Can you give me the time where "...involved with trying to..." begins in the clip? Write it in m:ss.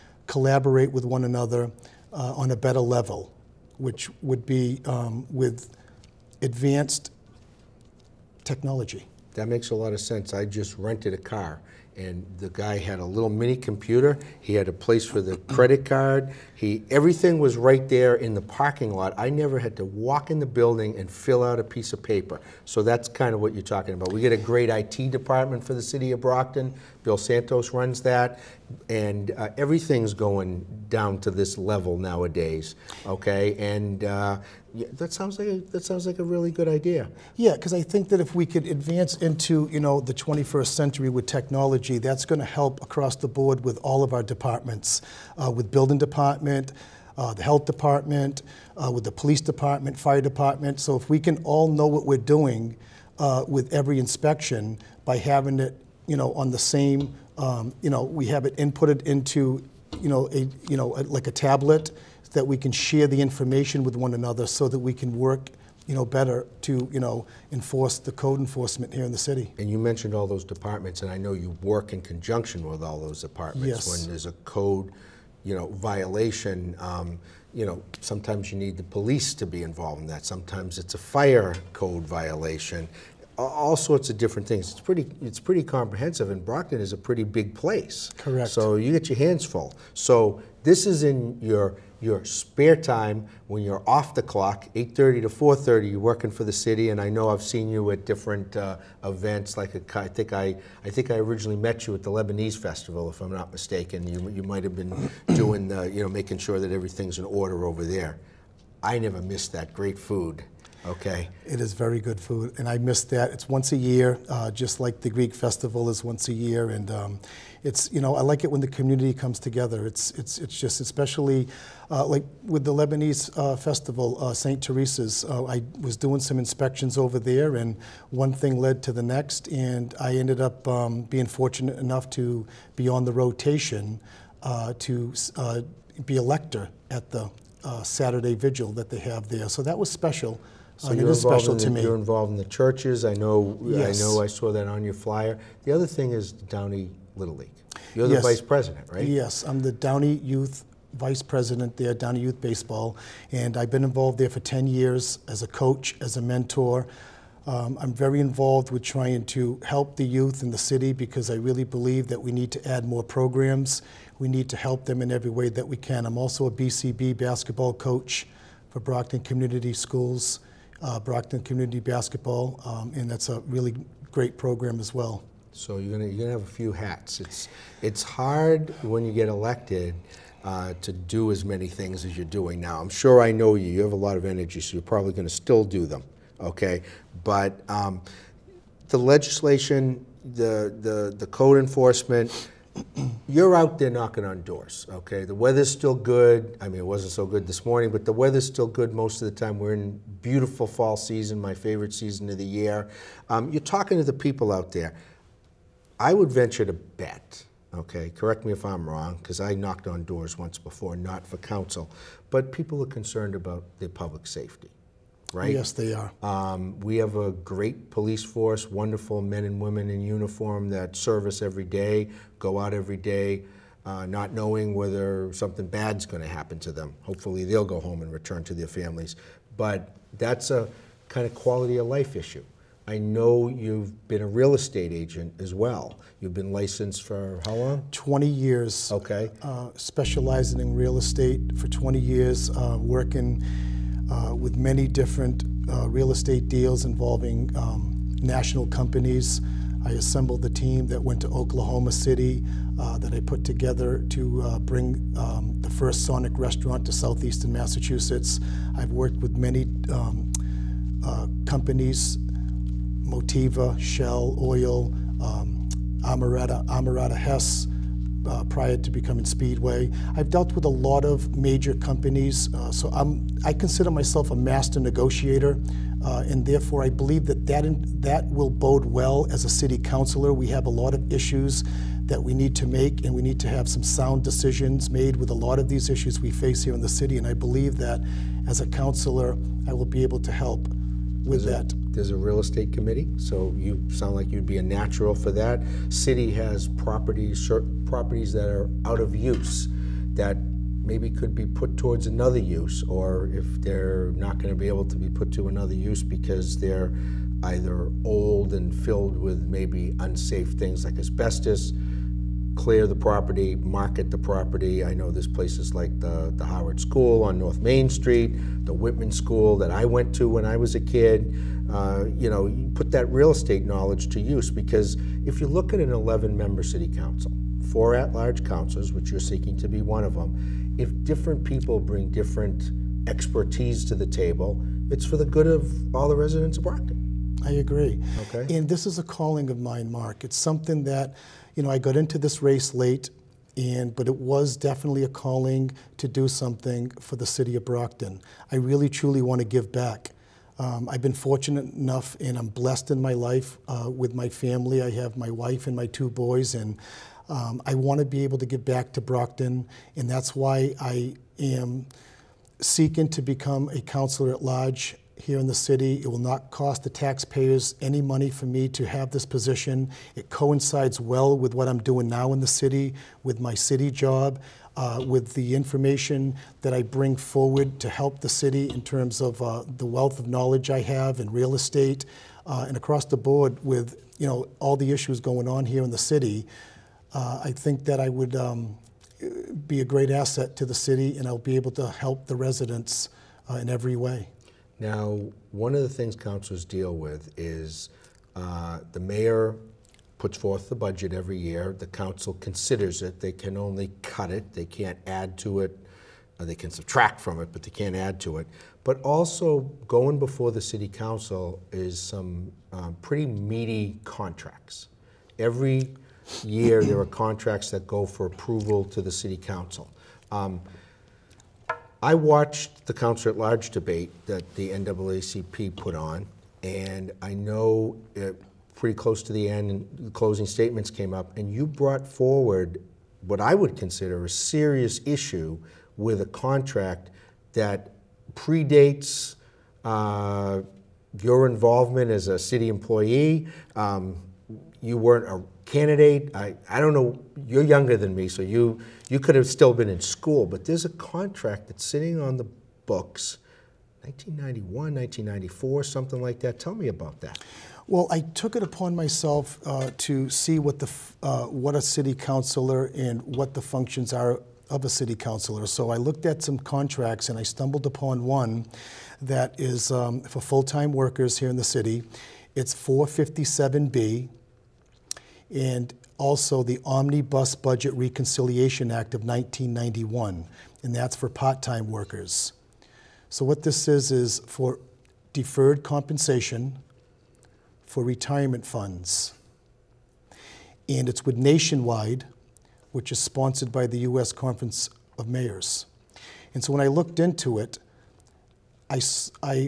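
2:38.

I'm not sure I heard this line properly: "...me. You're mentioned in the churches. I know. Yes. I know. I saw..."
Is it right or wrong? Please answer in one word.
wrong.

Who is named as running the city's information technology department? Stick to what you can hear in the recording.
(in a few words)
Bill Santos.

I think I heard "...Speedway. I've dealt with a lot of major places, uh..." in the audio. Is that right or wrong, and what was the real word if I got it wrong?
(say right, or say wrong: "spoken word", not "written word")
wrong: "companies", not "places".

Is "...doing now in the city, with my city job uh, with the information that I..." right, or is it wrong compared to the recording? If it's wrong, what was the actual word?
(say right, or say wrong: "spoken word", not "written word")
right.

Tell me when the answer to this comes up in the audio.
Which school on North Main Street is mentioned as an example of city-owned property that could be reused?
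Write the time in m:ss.
5:16.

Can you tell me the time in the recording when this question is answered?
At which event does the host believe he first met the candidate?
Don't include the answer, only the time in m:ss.
1:42.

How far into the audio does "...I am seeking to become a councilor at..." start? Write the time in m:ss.
6:00.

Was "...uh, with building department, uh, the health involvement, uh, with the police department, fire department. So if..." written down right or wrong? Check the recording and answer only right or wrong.
wrong.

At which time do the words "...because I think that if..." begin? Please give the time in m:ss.
0:37.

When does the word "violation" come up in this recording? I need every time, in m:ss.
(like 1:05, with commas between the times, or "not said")
1:15, 1:22.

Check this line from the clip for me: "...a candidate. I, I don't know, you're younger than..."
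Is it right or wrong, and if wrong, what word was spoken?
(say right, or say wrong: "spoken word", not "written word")
right.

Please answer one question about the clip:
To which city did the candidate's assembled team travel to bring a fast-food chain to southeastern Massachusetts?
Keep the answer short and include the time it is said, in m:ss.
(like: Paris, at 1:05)
Oklahoma City, at 4:11.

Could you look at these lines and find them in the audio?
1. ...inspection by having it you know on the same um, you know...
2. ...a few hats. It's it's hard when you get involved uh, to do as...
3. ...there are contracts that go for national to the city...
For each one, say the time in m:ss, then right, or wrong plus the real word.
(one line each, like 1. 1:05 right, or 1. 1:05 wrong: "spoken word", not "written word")
1. 0:53 right
2. 2:56 wrong: "elected", not "involved"
3. 6:56 wrong: "approval", not "national".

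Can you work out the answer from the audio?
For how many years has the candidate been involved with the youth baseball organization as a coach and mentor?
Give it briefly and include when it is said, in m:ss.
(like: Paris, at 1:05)
10, at 2:34.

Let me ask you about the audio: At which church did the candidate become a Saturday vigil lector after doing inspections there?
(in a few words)
Saint Teresa's.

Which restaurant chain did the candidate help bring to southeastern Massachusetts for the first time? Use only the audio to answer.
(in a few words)
Sonic.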